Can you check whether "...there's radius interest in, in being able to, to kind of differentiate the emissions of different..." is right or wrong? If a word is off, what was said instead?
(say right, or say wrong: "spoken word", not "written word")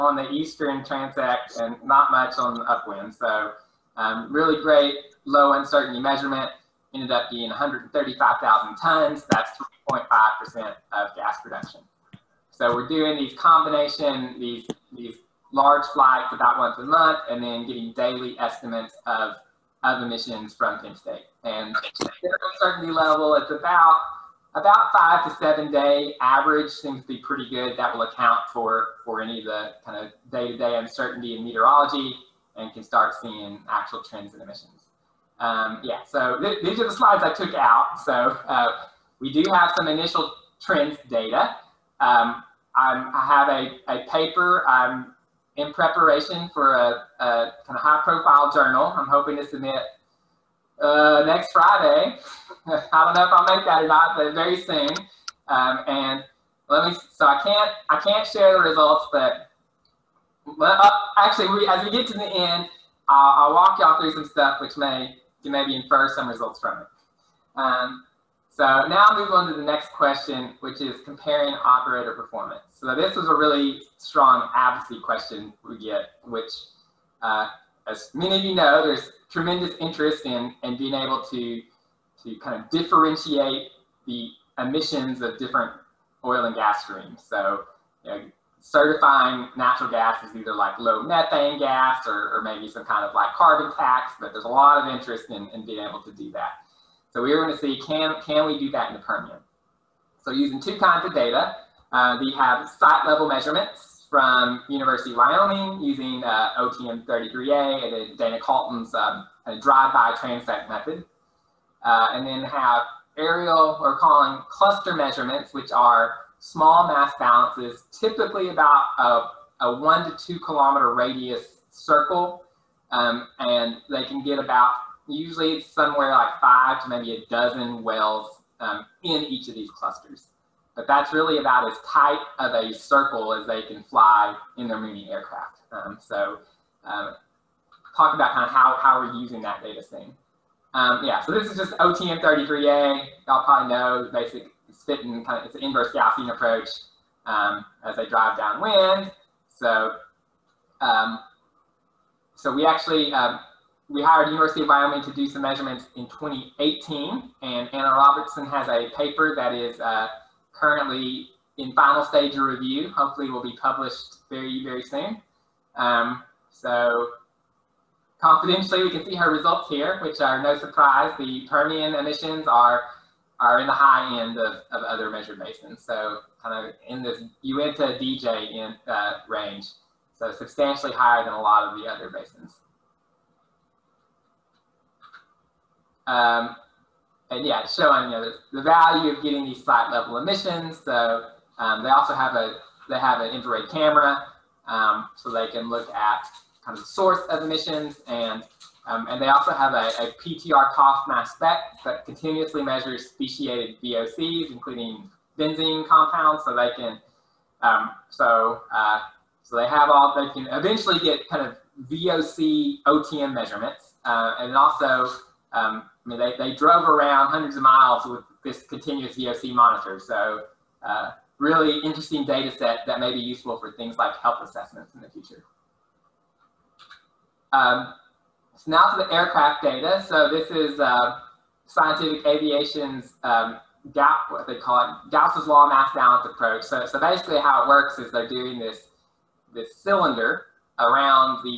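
wrong: "tremendous", not "radius".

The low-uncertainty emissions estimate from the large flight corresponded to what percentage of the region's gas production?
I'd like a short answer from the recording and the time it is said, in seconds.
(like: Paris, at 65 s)
3.5%, at 9 s.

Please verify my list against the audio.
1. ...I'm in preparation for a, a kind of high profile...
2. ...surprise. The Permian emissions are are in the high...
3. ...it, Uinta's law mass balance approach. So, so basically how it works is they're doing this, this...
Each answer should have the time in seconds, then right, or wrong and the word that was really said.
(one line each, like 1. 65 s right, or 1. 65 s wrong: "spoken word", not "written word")
1. 44 s right
2. 170 s right
3. 235 s wrong: "Gauss", not "Uinta".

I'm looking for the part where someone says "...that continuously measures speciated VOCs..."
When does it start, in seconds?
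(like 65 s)
201 s.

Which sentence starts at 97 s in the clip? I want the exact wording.
So we are going to see, can, can we do that in the Permian?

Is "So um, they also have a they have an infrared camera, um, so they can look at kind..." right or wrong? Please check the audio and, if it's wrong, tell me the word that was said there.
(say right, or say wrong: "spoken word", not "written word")
right.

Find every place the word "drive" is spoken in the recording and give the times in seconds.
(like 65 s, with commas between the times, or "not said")
109 s, 148 s.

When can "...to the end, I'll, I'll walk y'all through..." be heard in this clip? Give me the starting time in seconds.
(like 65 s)
62 s.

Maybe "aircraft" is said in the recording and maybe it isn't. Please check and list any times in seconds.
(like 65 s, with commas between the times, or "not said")
135 s, 229 s.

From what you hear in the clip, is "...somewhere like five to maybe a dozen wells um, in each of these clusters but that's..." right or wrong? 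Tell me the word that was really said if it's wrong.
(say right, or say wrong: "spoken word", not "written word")
right.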